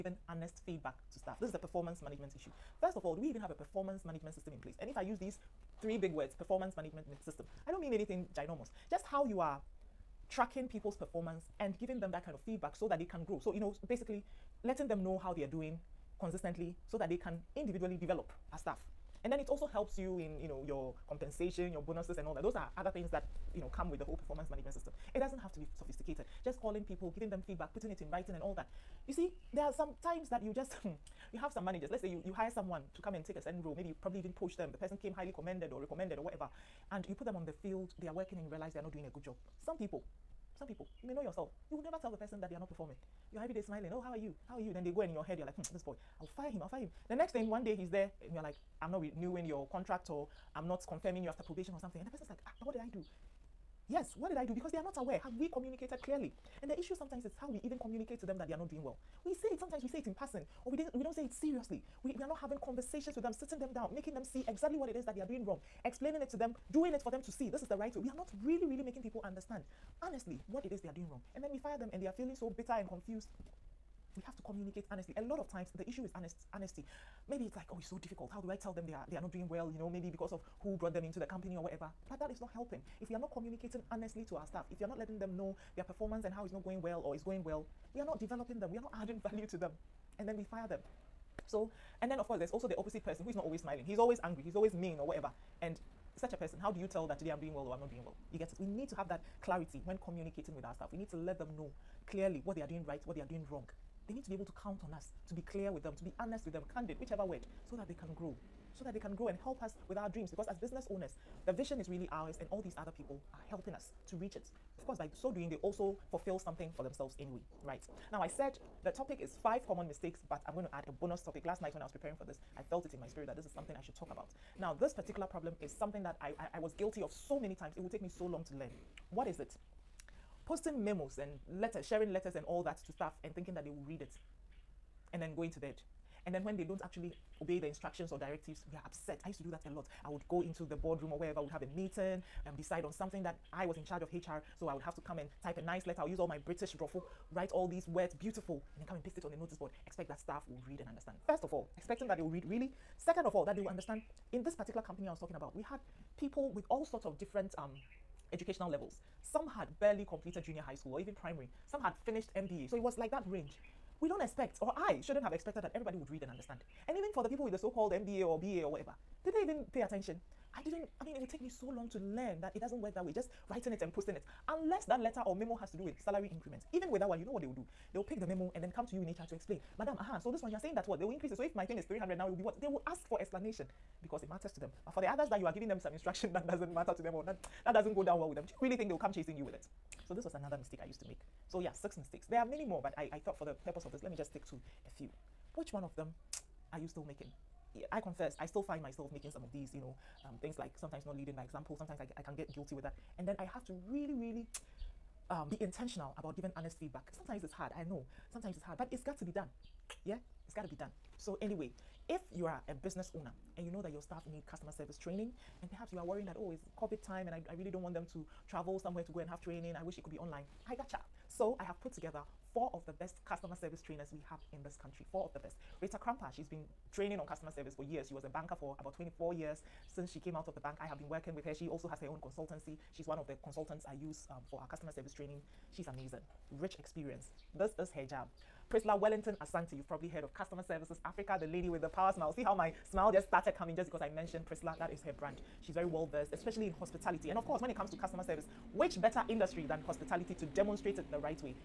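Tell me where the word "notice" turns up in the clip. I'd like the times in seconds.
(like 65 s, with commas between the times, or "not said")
149 s.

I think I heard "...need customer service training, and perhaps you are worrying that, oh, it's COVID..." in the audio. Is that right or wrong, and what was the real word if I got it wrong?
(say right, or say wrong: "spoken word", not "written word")
right.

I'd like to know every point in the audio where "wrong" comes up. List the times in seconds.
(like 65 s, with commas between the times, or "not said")
65 s, 71 s, 103 s.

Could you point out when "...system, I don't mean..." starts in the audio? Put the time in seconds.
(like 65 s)
7 s.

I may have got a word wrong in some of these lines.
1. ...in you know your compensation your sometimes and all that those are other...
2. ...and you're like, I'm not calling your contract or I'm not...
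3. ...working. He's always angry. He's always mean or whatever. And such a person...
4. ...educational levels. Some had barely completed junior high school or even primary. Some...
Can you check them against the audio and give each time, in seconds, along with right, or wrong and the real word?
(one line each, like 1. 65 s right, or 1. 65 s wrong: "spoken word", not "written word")
1. 20 s wrong: "bonuses", not "sometimes"
2. 48 s wrong: "renewing", not "calling"
3. 93 s wrong: "smiling", not "working"
4. 158 s right.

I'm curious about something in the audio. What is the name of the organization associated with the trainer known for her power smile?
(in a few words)
Customer Services Africa.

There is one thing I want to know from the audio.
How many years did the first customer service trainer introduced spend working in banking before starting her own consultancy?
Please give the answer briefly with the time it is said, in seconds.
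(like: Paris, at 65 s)
24 years, at 228 s.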